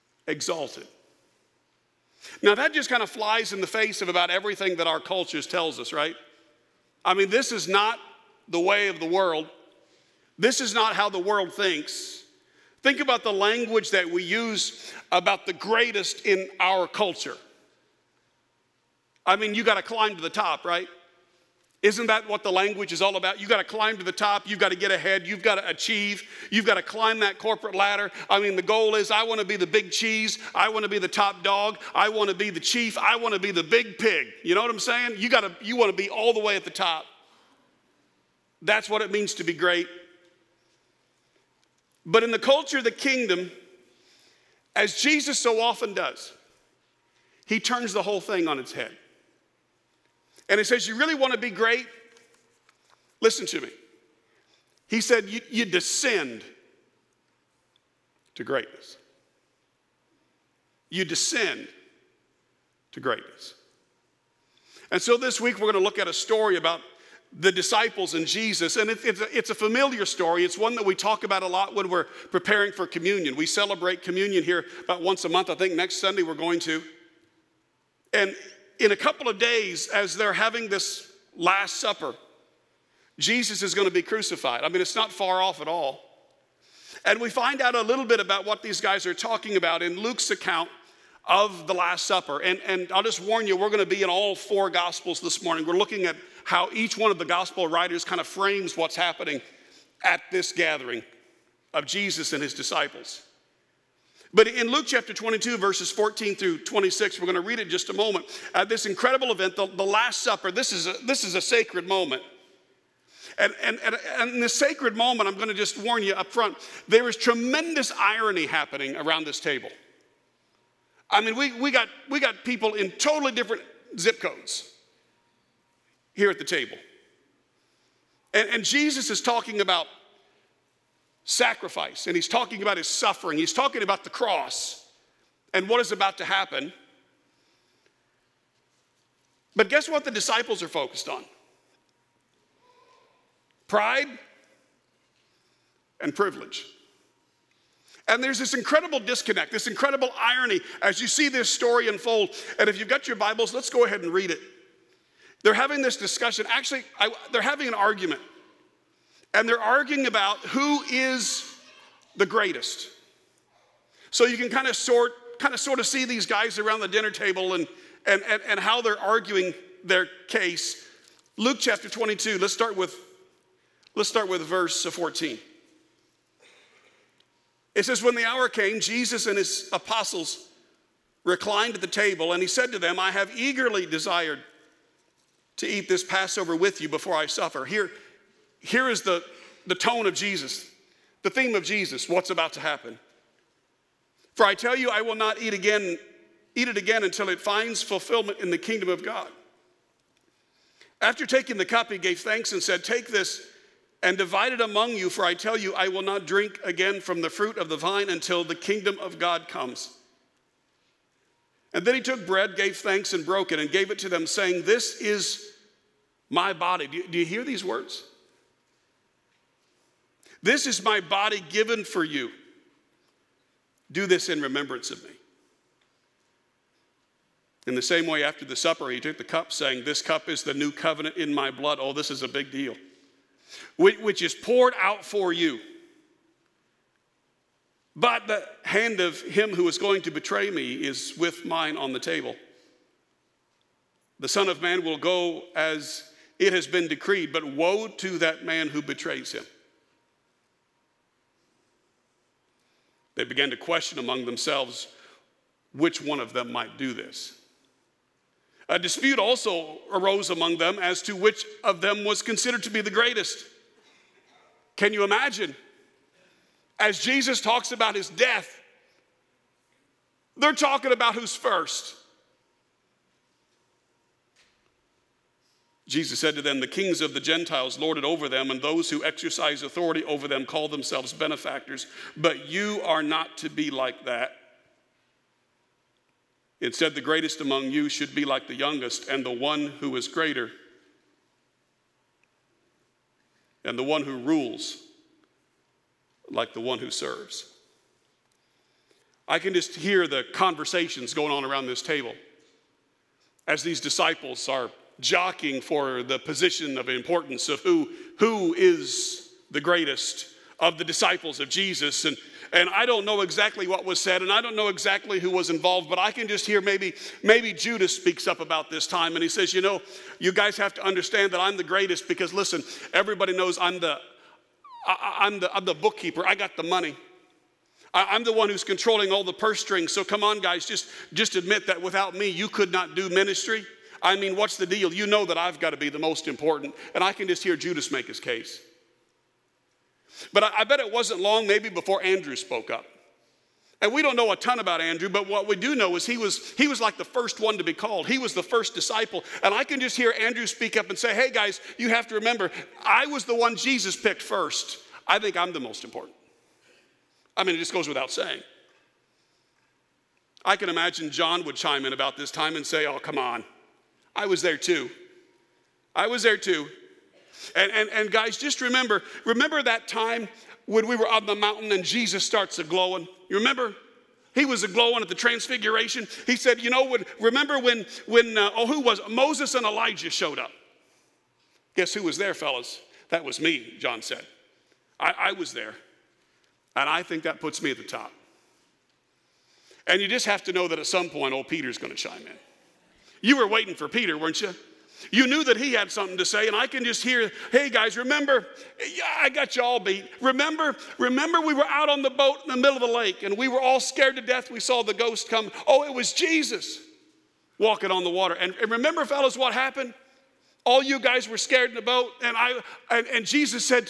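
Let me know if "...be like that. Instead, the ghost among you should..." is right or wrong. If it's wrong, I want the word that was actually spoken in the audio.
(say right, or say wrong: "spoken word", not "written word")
wrong: "greatest", not "ghost".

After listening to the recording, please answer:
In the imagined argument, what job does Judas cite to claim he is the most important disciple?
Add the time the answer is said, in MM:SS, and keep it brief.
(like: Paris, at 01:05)
Bookkeeper, at 05:25.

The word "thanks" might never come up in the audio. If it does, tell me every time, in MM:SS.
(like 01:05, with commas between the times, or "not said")
03:22, 03:32.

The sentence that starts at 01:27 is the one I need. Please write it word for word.
And we find out a little bit about what these guys are talking about in Luke's account of the Last Supper.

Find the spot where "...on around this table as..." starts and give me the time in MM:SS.
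05:01.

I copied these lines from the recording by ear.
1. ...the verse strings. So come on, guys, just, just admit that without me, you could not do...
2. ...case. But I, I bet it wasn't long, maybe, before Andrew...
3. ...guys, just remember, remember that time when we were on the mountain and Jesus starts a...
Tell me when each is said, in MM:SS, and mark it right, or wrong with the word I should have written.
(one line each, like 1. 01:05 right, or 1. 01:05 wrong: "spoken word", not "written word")
1. 05:29 wrong: "purse", not "verse"
2. 05:38 right
3. 06:08 right.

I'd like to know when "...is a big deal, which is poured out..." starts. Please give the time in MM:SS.
03:52.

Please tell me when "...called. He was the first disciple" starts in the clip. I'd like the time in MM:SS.
05:47.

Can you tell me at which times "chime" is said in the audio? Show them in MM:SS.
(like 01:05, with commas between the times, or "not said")
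06:01, 06:31.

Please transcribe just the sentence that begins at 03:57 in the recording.
But the hand of him who is going to betray me is with mine on the table.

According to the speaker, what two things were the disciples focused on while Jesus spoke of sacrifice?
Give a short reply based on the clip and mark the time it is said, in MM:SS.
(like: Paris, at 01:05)
Pride and privilege, at 02:23.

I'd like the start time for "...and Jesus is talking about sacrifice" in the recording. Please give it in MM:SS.
02:08.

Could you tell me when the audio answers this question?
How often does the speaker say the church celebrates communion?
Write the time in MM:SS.
01:14.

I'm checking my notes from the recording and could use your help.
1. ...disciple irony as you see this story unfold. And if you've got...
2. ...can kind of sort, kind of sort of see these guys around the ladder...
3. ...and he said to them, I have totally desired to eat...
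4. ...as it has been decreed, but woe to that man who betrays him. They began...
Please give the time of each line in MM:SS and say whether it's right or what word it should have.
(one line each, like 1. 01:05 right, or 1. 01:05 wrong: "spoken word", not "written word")
1. 02:29 wrong: "incredible", not "disciple"
2. 02:44 wrong: "dinner", not "ladder"
3. 03:02 wrong: "eagerly", not "totally"
4. 04:05 right.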